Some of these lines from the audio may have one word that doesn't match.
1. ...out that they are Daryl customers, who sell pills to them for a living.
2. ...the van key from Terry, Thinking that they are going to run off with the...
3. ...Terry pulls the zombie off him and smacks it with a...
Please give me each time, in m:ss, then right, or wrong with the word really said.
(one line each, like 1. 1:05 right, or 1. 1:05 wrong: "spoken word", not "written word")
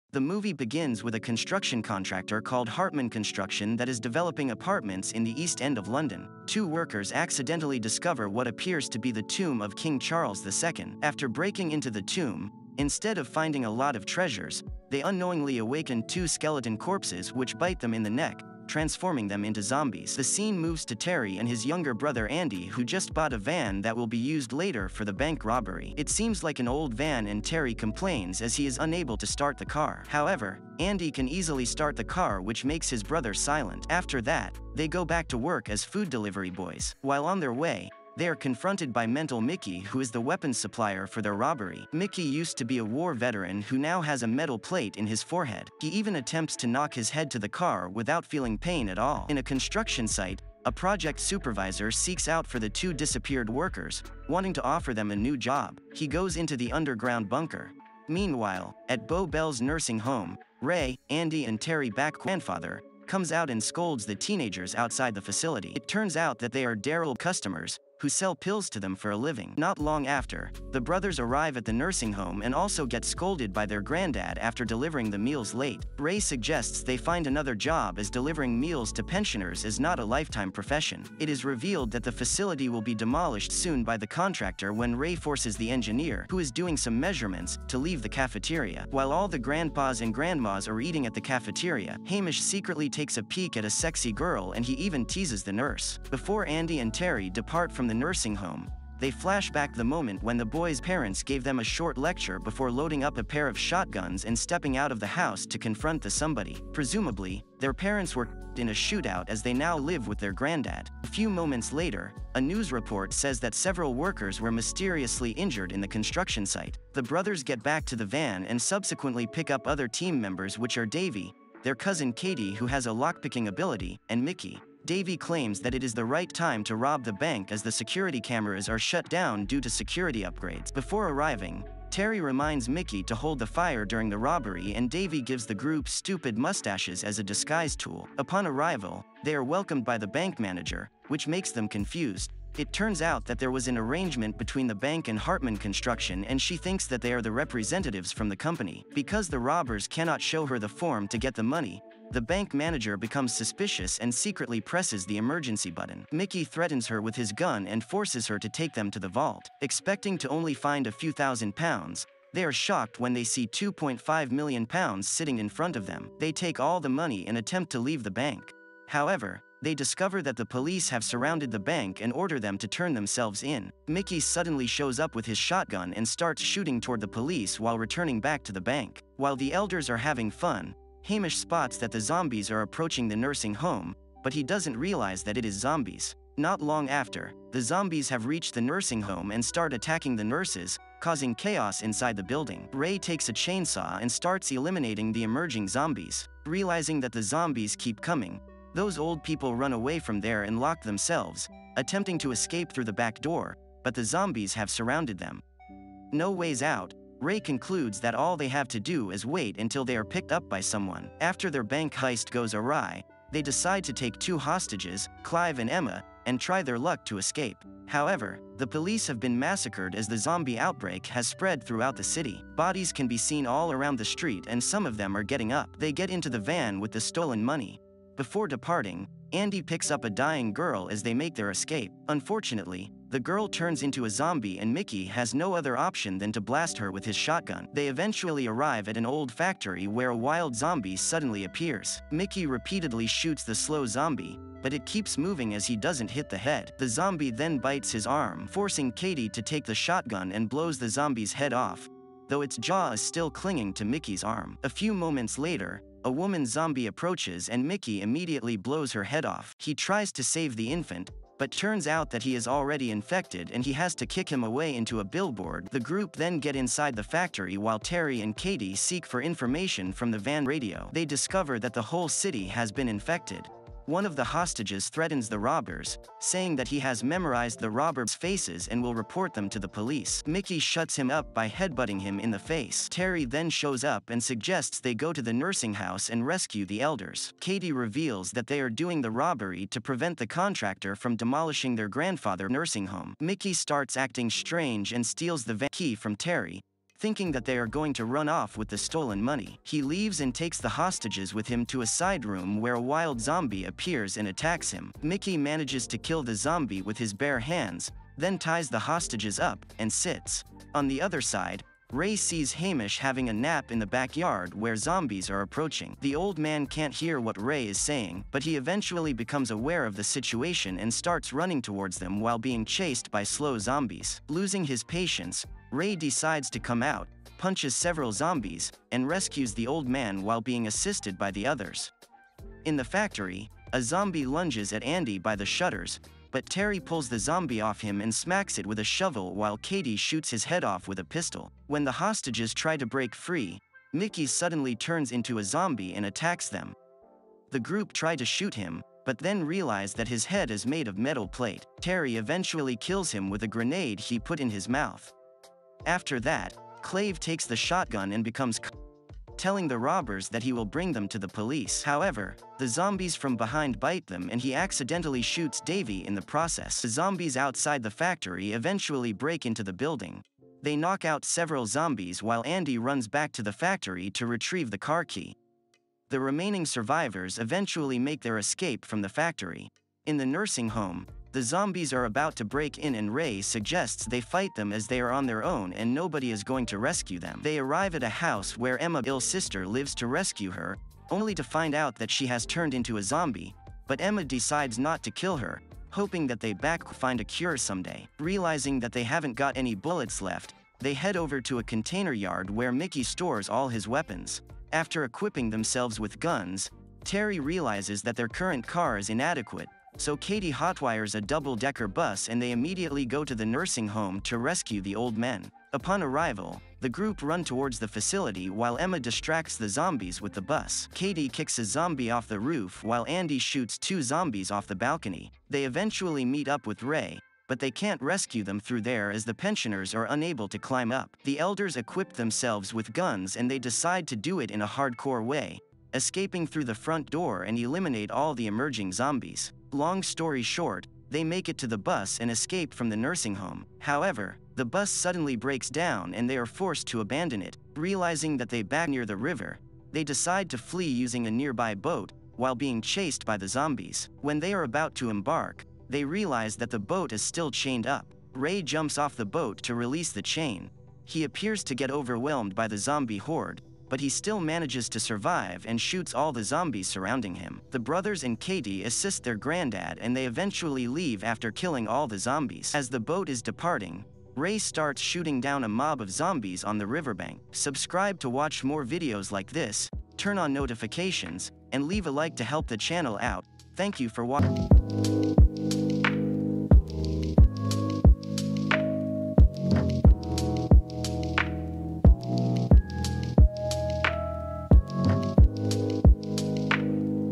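1. 1:06 right
2. 4:55 right
3. 5:36 right.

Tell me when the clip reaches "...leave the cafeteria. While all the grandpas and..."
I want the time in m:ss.
1:27.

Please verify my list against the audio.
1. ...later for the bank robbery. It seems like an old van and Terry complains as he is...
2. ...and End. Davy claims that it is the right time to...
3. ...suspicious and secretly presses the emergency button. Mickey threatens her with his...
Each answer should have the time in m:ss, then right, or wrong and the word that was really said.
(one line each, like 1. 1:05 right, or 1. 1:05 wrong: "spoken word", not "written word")
1. 0:24 right
2. 2:04 wrong: "Mickey", not "End"
3. 2:33 right.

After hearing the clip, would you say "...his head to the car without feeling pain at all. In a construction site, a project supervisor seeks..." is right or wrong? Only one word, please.
right.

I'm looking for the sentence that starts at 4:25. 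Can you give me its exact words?
The group then get inside the factory while Terry and Katie seek for information from the van radio.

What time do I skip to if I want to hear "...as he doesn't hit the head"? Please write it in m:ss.
4:05.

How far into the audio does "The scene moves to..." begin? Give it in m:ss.
0:20.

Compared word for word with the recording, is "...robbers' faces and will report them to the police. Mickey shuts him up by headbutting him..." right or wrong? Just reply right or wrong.
right.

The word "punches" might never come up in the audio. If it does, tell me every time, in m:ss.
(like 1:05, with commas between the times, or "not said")
5:27.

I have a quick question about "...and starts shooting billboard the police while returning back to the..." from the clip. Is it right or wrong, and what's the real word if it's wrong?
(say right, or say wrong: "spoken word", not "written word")
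wrong: "toward", not "billboard".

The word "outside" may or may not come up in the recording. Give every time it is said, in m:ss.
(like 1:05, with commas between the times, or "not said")
1:04, 6:07.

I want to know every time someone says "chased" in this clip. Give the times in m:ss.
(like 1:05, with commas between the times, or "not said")
5:22, 7:32.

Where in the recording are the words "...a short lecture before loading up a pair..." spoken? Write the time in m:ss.
1:41.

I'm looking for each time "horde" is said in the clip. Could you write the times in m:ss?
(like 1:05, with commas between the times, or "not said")
7:43.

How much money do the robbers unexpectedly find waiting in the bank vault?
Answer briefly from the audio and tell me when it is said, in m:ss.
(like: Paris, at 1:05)
2.5 million pounds, at 2:43.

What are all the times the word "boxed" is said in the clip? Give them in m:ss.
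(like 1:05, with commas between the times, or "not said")
not said.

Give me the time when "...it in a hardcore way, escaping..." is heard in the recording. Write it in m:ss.
7:14.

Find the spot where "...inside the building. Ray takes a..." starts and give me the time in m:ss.
3:11.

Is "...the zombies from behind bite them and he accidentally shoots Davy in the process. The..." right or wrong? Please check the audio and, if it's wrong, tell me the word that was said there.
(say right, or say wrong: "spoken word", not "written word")
right.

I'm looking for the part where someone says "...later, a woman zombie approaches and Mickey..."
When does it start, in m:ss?
4:15.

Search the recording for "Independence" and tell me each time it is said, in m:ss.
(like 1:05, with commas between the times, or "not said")
not said.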